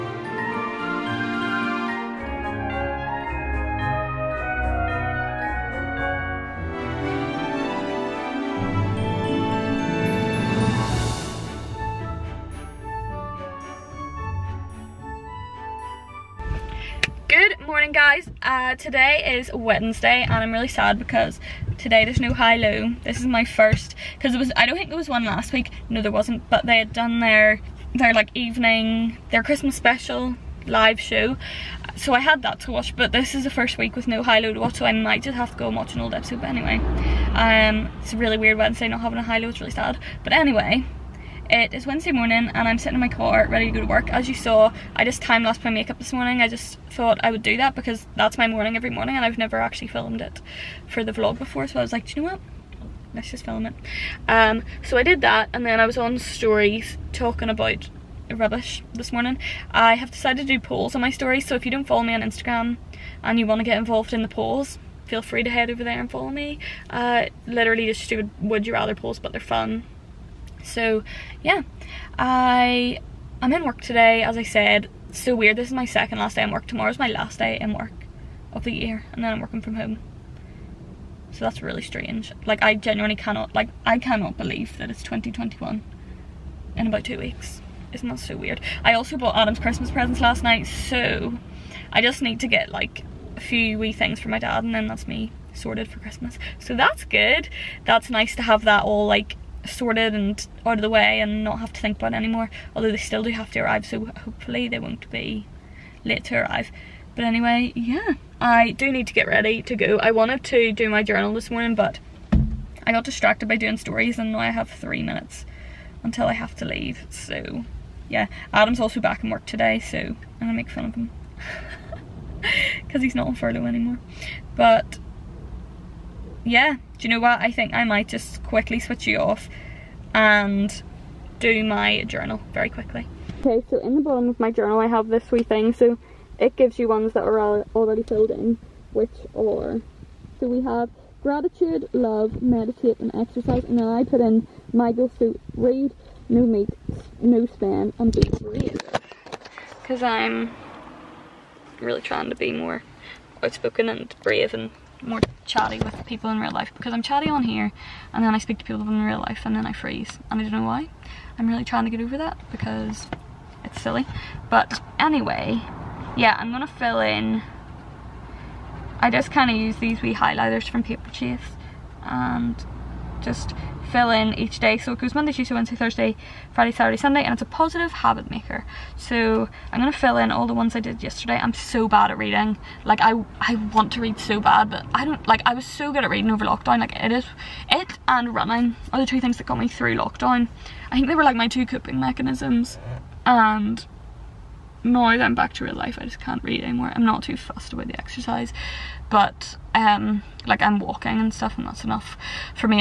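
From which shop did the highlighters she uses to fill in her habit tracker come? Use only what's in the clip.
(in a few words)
Paperchase.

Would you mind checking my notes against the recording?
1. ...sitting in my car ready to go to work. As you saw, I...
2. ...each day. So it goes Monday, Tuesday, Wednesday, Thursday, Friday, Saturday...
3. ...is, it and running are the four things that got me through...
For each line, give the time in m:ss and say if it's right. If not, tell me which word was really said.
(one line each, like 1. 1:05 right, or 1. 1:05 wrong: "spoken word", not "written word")
1. 0:42 right
2. 2:54 right
3. 3:07 wrong: "two", not "four".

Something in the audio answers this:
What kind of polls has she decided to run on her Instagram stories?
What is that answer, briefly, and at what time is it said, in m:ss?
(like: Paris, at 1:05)
Would you rather polls, at 1:08.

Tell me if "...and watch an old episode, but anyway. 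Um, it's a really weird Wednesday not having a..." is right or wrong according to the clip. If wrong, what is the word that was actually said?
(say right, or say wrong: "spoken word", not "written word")
right.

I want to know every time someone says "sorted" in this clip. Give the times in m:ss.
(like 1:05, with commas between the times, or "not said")
1:35, 1:39.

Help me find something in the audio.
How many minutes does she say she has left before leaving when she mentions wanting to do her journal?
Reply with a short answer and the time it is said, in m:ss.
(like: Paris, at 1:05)
3, at 1:54.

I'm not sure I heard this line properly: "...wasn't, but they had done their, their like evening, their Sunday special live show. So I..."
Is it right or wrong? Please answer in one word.
wrong.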